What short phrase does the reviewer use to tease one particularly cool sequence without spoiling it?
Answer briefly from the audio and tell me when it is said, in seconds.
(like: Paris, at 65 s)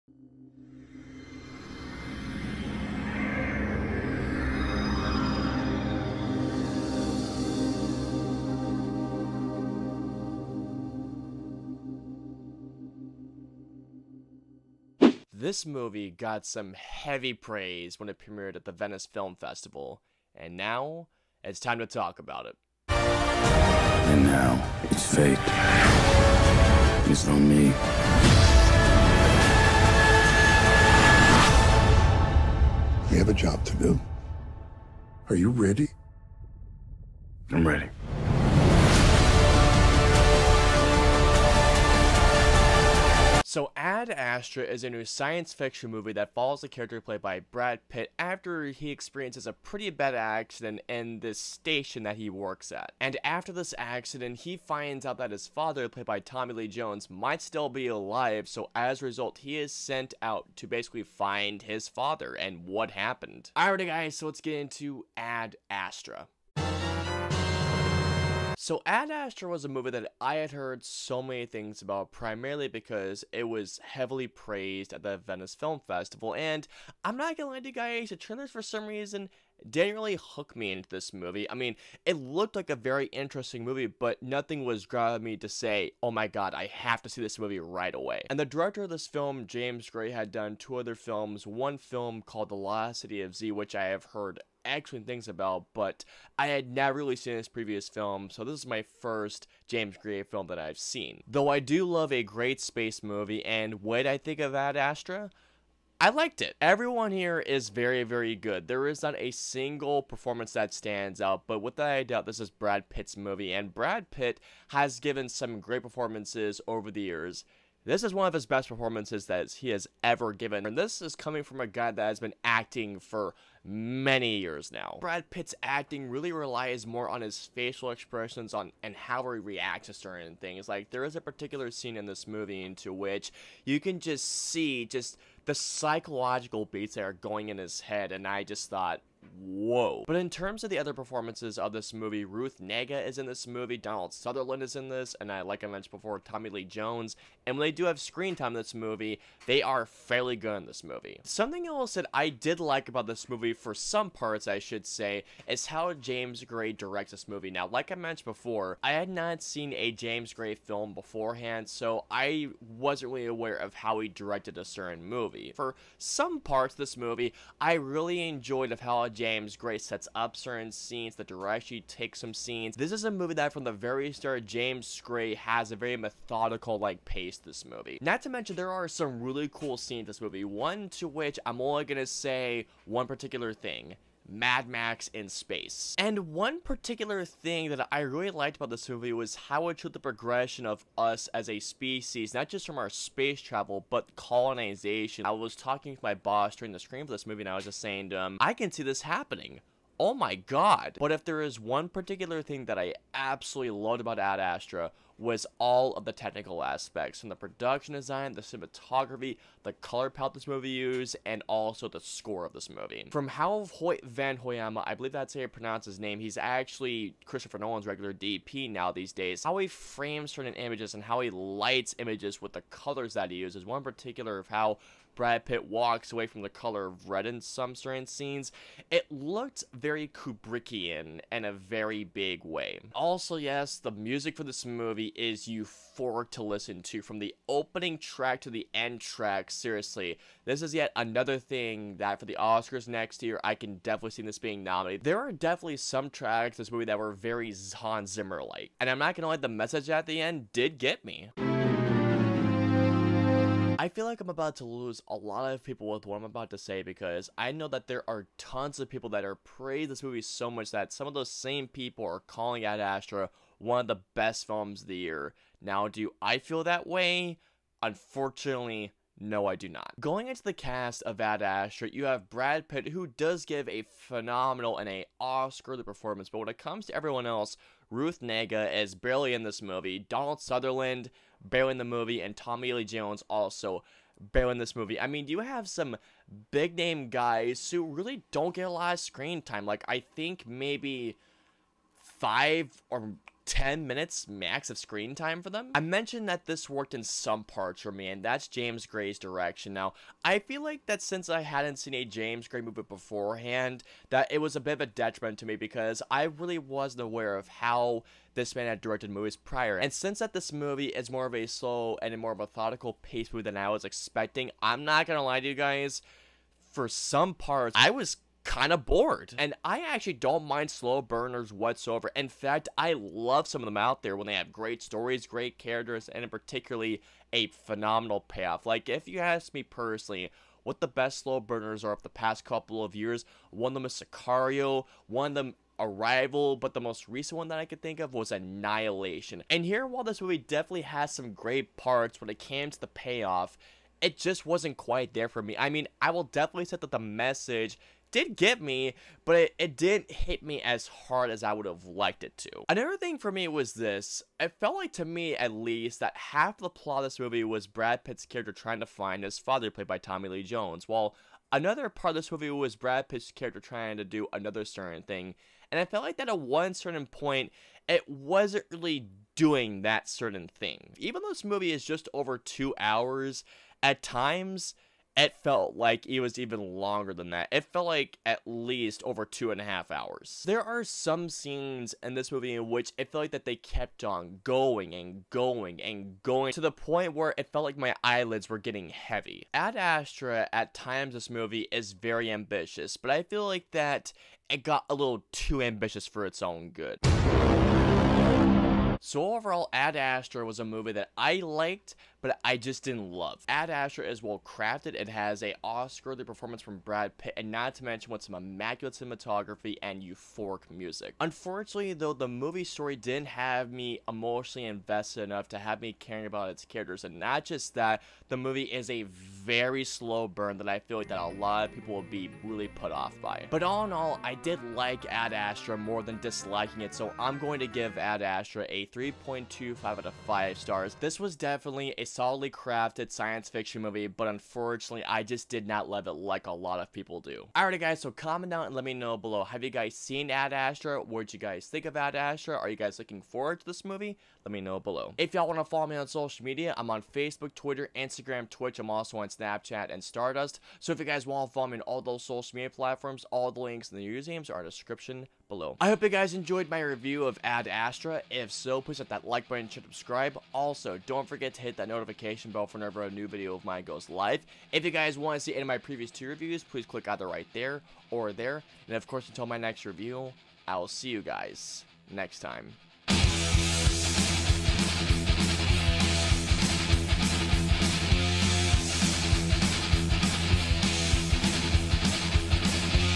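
Mad Max in space, at 184 s.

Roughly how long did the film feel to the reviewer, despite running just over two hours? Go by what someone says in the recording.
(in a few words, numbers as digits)
over two and a half hours.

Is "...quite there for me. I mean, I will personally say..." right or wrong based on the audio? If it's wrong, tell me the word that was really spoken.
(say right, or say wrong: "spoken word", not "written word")
wrong: "definitely", not "personally".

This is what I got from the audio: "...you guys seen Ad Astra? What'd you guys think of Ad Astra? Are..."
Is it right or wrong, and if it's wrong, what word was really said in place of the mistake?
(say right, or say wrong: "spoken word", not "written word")
right.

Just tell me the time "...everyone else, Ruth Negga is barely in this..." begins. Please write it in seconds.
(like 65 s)
276 s.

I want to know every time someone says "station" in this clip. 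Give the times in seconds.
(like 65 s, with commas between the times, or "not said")
51 s.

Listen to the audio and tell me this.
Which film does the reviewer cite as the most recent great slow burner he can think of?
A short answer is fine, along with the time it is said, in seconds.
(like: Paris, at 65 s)
Annihilation, at 338 s.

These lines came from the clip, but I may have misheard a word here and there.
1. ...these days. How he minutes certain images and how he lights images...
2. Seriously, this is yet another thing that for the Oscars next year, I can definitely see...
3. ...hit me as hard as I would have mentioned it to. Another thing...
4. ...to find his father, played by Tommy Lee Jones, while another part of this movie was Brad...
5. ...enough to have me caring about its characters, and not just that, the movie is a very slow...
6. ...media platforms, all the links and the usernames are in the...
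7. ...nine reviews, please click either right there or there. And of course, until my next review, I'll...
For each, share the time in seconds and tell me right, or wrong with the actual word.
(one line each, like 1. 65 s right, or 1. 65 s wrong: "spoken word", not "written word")
1. 218 s wrong: "frames", not "minutes"
2. 239 s right
3. 350 s wrong: "liked", not "mentioned"
4. 358 s right
5. 415 s right
6. 452 s right
7. 466 s wrong: "two", not "nine".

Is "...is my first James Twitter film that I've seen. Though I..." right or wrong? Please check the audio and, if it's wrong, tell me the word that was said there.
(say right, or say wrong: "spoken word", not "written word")
wrong: "Gray", not "Twitter".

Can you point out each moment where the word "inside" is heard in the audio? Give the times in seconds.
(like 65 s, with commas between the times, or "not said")
not said.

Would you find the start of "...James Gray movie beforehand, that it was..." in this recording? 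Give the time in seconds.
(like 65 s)
302 s.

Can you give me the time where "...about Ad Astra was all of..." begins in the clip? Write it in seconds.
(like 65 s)
204 s.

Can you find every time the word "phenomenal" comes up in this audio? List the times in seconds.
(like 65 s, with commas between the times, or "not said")
273 s, 327 s.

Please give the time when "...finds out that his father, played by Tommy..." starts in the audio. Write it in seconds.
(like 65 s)
54 s.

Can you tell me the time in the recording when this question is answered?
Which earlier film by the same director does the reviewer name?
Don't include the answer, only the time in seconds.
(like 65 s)
92 s.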